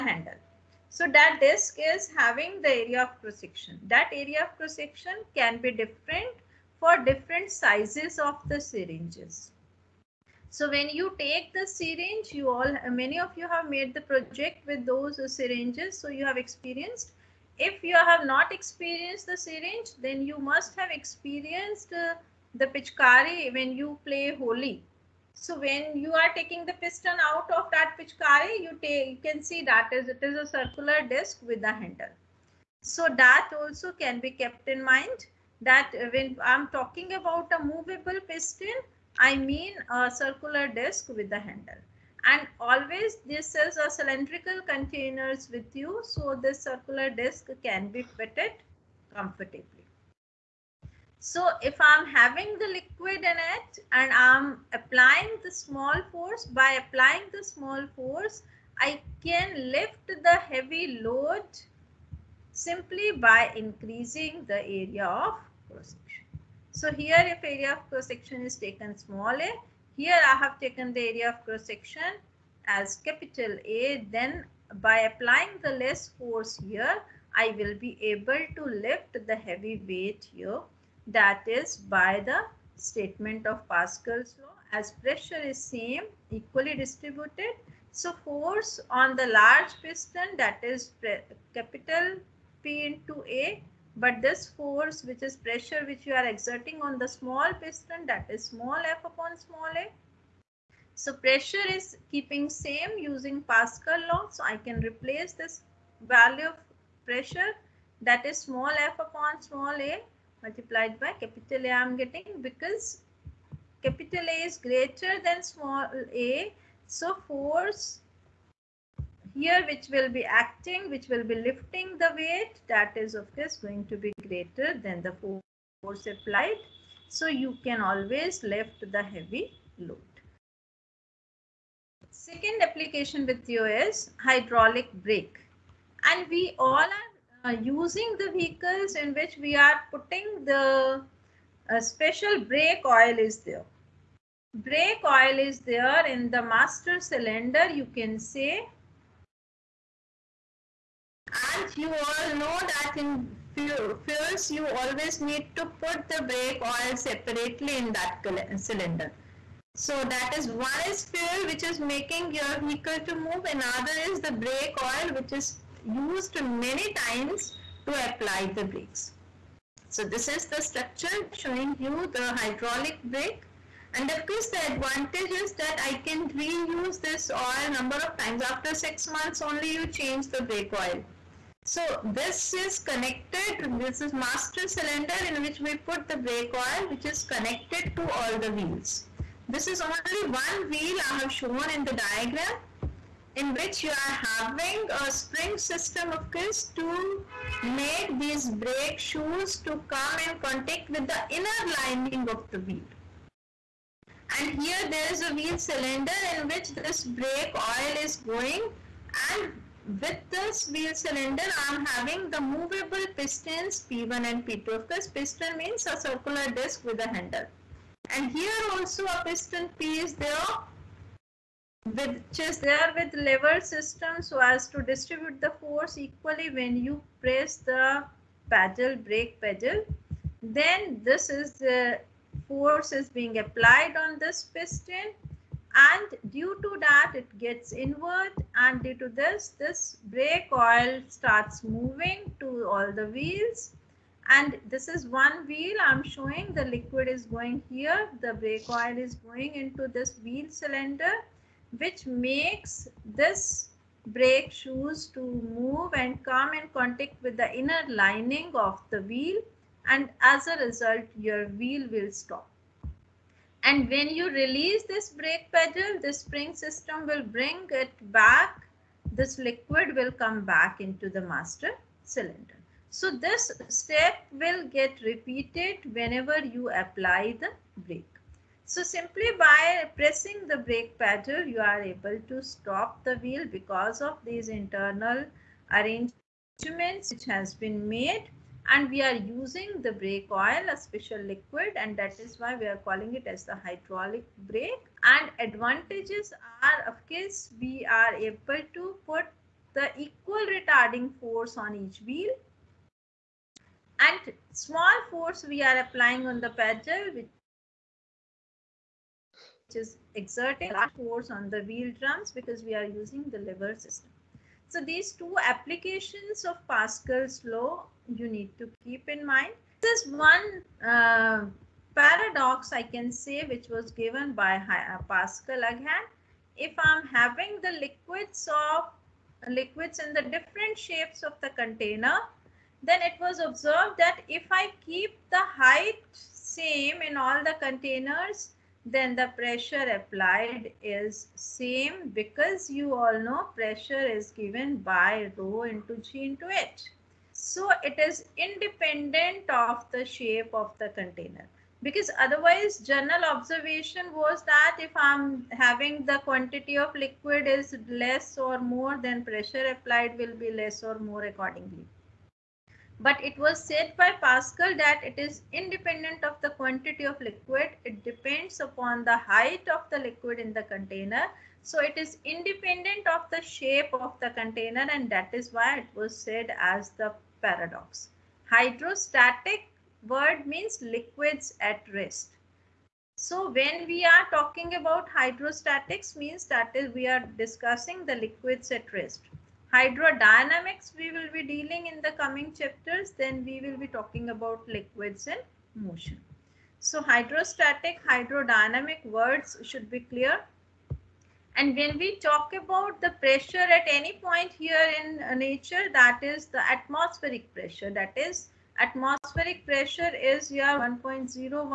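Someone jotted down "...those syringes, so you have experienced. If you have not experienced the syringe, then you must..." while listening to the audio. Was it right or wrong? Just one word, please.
right.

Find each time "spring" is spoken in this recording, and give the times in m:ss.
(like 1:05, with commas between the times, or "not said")
3:15, 4:26.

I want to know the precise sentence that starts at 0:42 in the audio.
And always this is a cylindrical containers with you.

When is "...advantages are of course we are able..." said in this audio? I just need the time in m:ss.
4:55.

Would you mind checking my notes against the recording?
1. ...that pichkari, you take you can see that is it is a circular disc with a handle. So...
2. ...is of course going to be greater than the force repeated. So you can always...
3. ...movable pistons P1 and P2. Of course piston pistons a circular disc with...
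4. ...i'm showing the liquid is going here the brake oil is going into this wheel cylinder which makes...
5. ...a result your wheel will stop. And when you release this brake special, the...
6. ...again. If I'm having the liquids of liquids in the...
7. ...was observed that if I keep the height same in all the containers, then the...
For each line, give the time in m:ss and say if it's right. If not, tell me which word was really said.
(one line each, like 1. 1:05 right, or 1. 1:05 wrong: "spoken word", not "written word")
1. 0:27 right
2. 2:02 wrong: "applied", not "repeated"
3. 3:32 wrong: "means", not "pistons"
4. 4:05 right
5. 4:20 wrong: "pedal", not "special"
6. 5:25 right
7. 5:33 right.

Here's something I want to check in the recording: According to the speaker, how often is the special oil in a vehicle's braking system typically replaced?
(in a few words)
After six months.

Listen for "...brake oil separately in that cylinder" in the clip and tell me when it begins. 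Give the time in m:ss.
2:36.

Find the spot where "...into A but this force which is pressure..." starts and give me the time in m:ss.
1:32.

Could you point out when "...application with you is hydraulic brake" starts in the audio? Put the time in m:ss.
2:12.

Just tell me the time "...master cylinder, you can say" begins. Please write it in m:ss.
2:26.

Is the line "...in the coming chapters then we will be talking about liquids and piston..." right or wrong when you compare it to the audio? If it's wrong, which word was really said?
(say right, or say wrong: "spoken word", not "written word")
wrong: "motion", not "piston".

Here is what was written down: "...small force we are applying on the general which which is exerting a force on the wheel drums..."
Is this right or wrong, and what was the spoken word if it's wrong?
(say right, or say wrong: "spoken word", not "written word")
wrong: "pedal", not "general".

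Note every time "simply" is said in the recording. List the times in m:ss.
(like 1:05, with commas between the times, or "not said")
1:02, 4:38.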